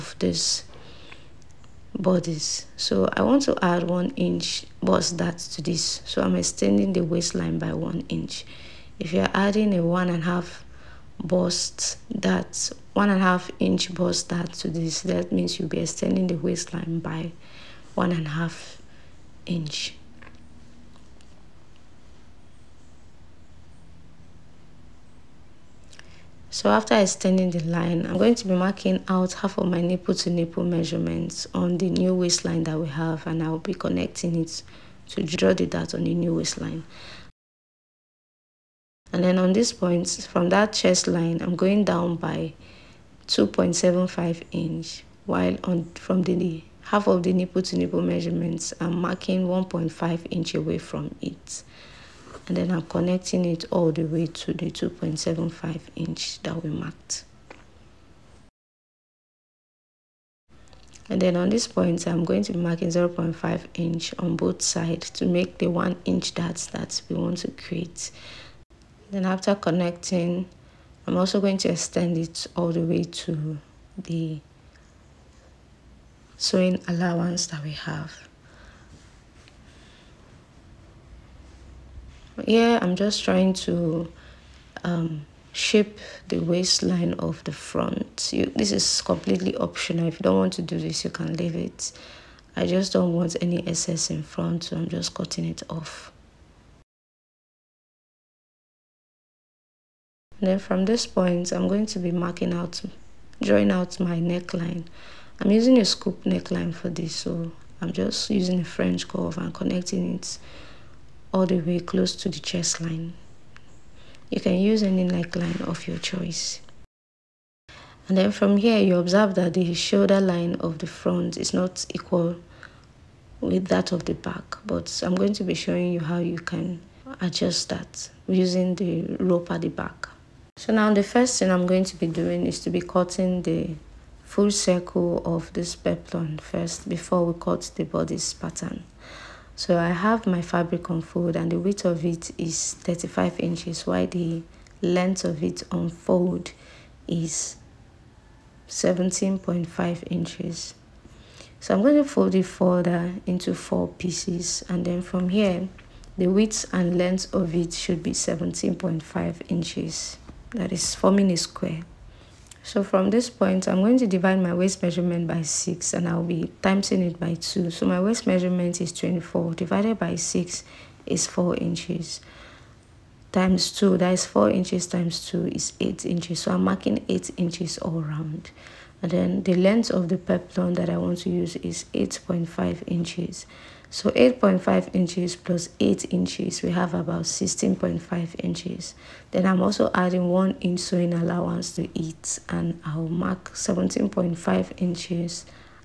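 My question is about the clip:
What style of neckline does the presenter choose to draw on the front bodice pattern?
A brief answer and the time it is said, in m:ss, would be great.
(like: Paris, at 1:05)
Scoop neckline, at 1:45.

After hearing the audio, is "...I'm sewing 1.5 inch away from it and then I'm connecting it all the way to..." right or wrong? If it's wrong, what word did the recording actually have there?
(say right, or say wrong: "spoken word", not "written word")
wrong: "marking", not "sewing".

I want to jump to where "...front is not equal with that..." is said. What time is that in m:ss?
2:00.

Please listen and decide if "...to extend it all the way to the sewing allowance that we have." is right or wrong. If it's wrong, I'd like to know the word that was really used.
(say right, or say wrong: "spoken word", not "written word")
right.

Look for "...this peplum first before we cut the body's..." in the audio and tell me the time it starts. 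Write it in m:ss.
2:15.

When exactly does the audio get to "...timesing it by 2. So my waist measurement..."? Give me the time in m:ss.
2:46.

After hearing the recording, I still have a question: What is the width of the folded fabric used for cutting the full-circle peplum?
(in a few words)
35 inches.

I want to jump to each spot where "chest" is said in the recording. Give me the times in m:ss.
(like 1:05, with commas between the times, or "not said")
0:40, 1:52.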